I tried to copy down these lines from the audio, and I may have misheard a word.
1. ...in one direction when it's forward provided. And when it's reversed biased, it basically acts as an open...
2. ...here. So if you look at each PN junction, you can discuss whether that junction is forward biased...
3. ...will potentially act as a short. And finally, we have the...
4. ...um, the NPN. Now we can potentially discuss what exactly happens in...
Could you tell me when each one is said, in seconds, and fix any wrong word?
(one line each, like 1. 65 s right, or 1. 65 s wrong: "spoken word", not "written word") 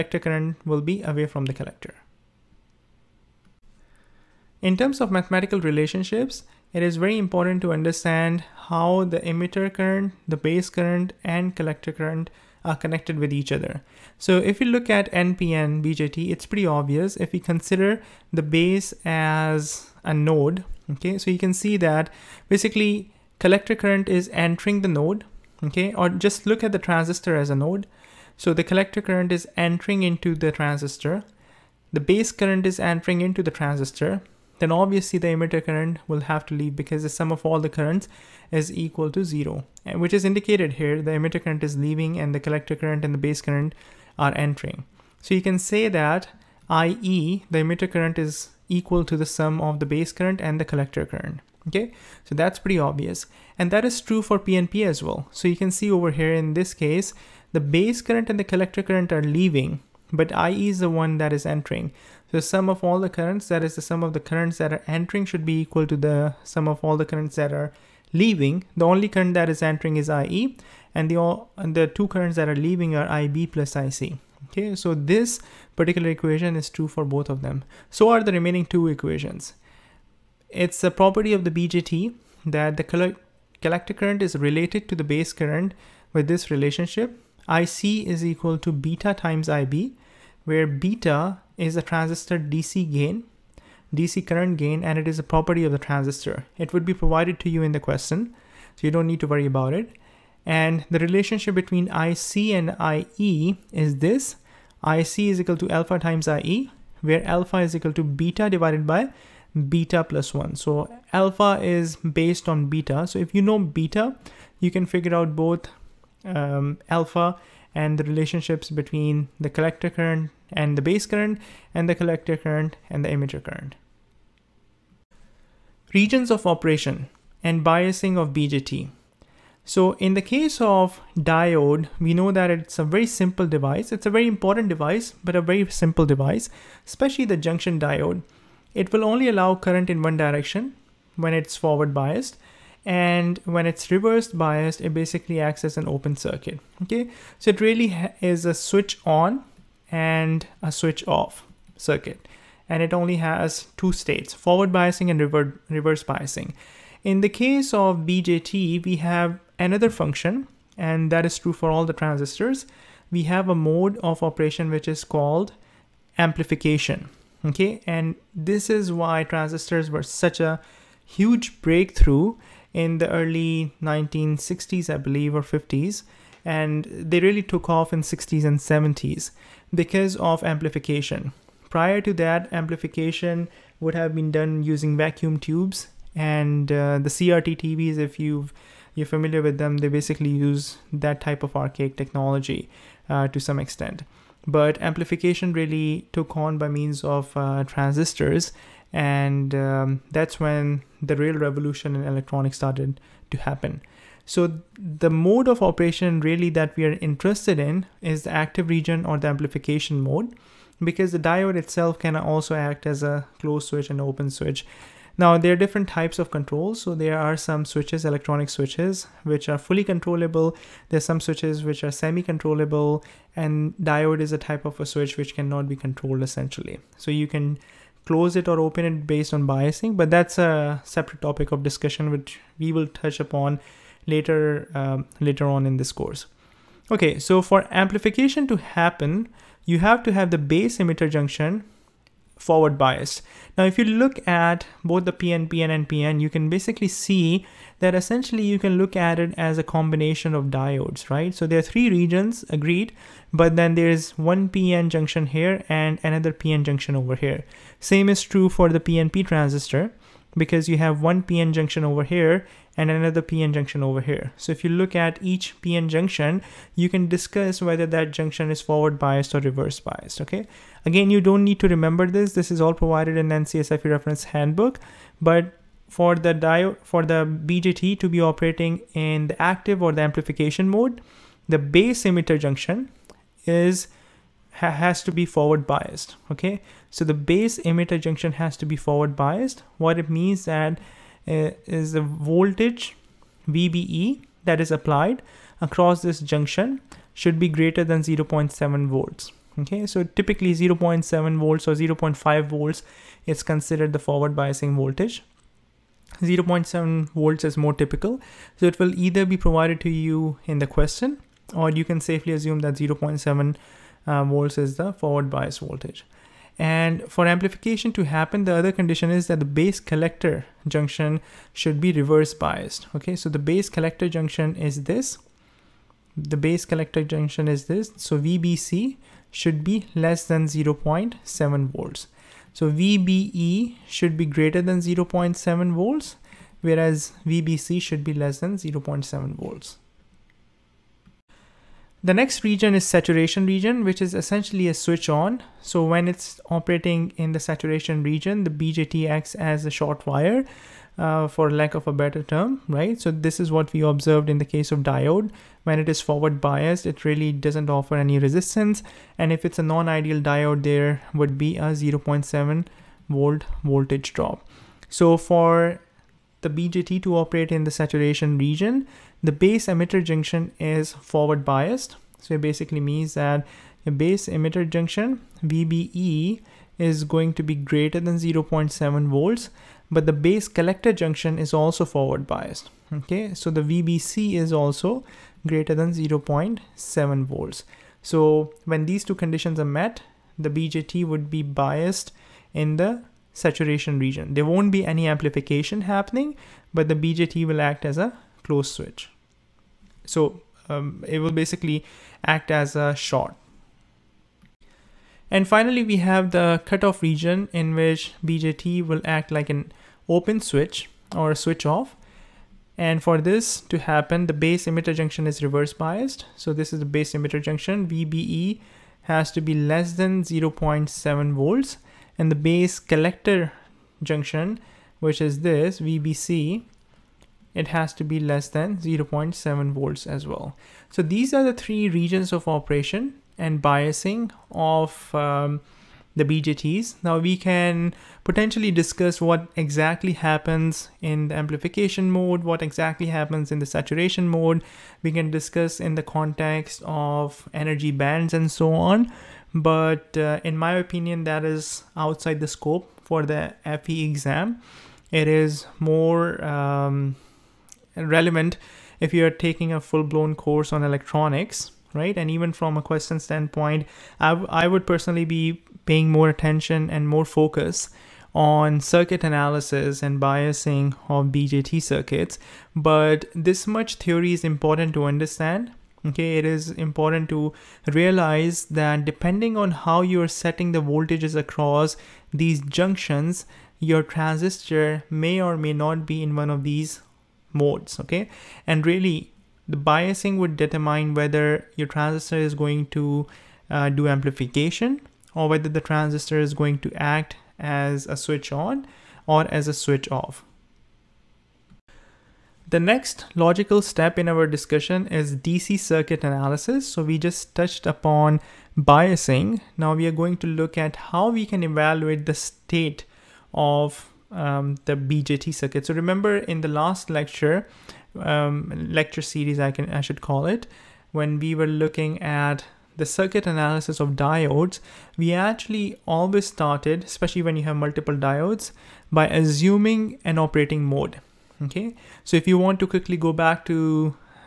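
1. 139 s wrong: "biased", not "provided"
2. 264 s right
3. 401 s wrong: "basically", not "potentially"
4. 435 s wrong: "BJTs", not "NPN".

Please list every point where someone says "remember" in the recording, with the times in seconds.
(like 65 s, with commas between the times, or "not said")
271 s, 515 s.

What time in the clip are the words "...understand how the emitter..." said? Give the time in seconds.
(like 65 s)
7 s.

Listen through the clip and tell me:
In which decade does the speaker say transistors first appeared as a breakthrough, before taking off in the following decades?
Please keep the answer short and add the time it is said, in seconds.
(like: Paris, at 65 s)
1960s, at 173 s.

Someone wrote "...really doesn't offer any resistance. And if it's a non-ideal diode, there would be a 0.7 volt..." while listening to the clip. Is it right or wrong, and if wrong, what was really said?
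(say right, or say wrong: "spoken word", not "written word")
right.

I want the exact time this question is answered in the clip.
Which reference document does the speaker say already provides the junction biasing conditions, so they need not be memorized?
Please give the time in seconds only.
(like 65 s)
273 s.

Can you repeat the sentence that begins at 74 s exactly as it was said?
Okay, so this particular equation is true for both of them.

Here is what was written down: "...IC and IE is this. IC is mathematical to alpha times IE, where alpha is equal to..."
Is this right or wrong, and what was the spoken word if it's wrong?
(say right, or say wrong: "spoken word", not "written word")
wrong: "equal", not "mathematical".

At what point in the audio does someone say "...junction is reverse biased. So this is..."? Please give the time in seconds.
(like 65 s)
414 s.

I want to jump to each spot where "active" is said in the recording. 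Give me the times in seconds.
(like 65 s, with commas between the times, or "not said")
208 s, 279 s.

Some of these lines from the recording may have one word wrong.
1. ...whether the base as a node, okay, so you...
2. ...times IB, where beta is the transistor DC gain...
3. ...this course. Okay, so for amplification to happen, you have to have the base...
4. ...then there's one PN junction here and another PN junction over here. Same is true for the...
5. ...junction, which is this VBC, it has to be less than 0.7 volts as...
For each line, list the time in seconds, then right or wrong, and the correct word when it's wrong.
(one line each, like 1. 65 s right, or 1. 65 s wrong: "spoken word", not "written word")
1. 17 s wrong: "consider", not "whether"
2. 89 s right
3. 235 s right
4. 253 s right
5. 424 s right.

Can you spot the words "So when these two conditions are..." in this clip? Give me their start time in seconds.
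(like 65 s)
388 s.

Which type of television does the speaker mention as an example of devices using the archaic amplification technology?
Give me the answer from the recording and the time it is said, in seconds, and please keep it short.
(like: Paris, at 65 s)
CRT TVs, at 187 s.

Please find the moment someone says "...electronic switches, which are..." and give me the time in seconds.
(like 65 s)
218 s.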